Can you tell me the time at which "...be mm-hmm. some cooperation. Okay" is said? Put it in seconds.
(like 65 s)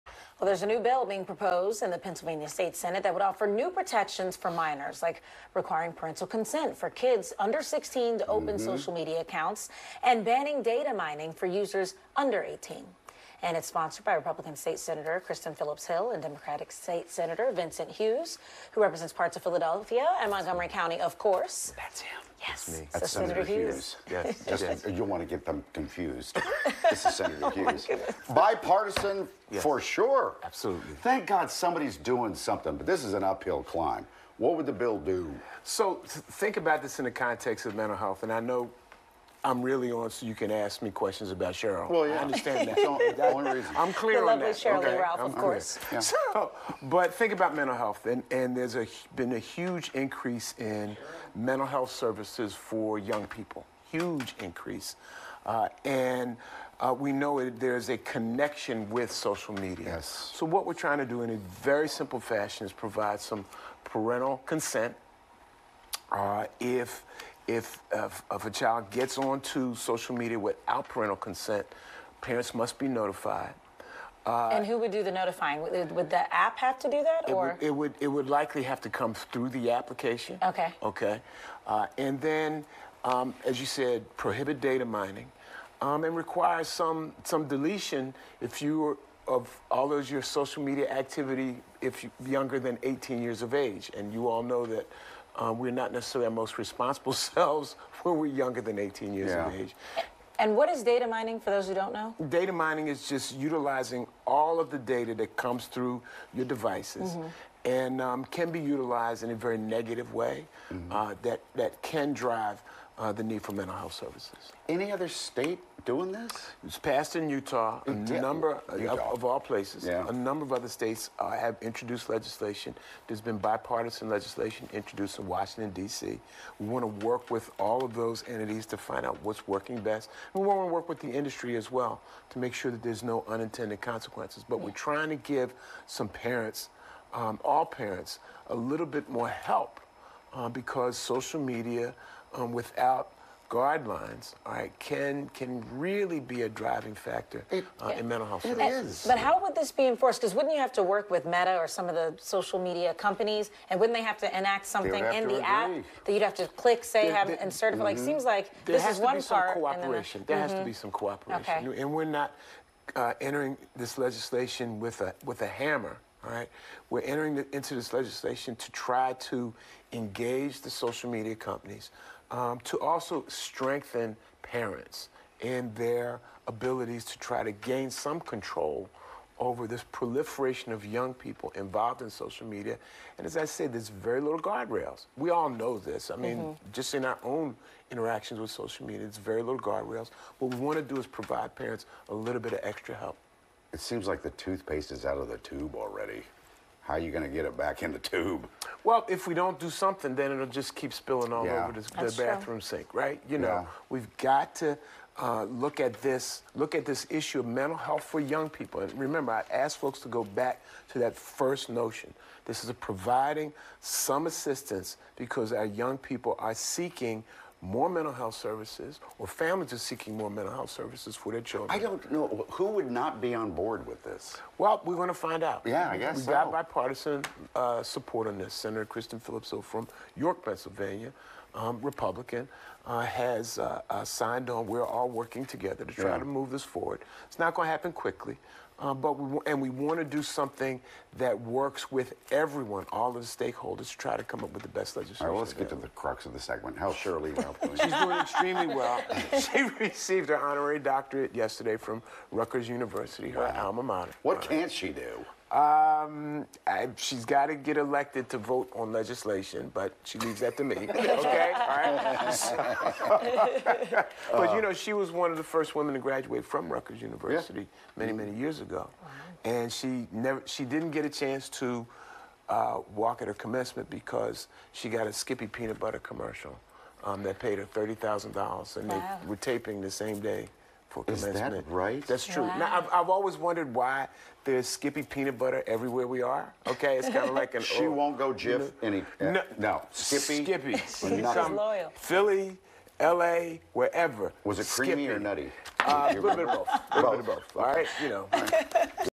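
160 s.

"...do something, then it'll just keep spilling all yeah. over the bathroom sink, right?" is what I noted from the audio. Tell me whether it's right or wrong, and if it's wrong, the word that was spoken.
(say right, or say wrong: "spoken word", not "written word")
right.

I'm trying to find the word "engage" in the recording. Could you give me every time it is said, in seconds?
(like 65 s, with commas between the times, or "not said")
169 s.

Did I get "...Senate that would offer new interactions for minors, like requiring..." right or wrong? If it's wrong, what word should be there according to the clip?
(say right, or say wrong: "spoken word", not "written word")
wrong: "protections", not "interactions".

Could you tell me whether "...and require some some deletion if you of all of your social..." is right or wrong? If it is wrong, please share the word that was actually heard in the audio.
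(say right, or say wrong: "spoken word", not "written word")
right.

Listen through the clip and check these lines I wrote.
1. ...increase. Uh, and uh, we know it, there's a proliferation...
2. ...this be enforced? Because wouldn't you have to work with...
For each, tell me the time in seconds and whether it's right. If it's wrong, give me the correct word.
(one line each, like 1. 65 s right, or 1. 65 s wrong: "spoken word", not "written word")
1. 54 s wrong: "connection", not "proliferation"
2. 149 s right.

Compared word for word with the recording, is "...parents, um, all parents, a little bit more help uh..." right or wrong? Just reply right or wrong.
right.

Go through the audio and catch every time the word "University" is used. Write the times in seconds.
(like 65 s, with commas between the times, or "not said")
252 s, 267 s.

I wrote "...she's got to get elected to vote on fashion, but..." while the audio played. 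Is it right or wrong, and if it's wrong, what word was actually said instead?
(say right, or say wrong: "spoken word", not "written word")
wrong: "legislation", not "fashion".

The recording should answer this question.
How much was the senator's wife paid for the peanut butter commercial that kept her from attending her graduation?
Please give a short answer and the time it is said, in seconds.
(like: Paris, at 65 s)
$30,000, at 277 s.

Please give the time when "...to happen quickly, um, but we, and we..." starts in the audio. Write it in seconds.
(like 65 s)
237 s.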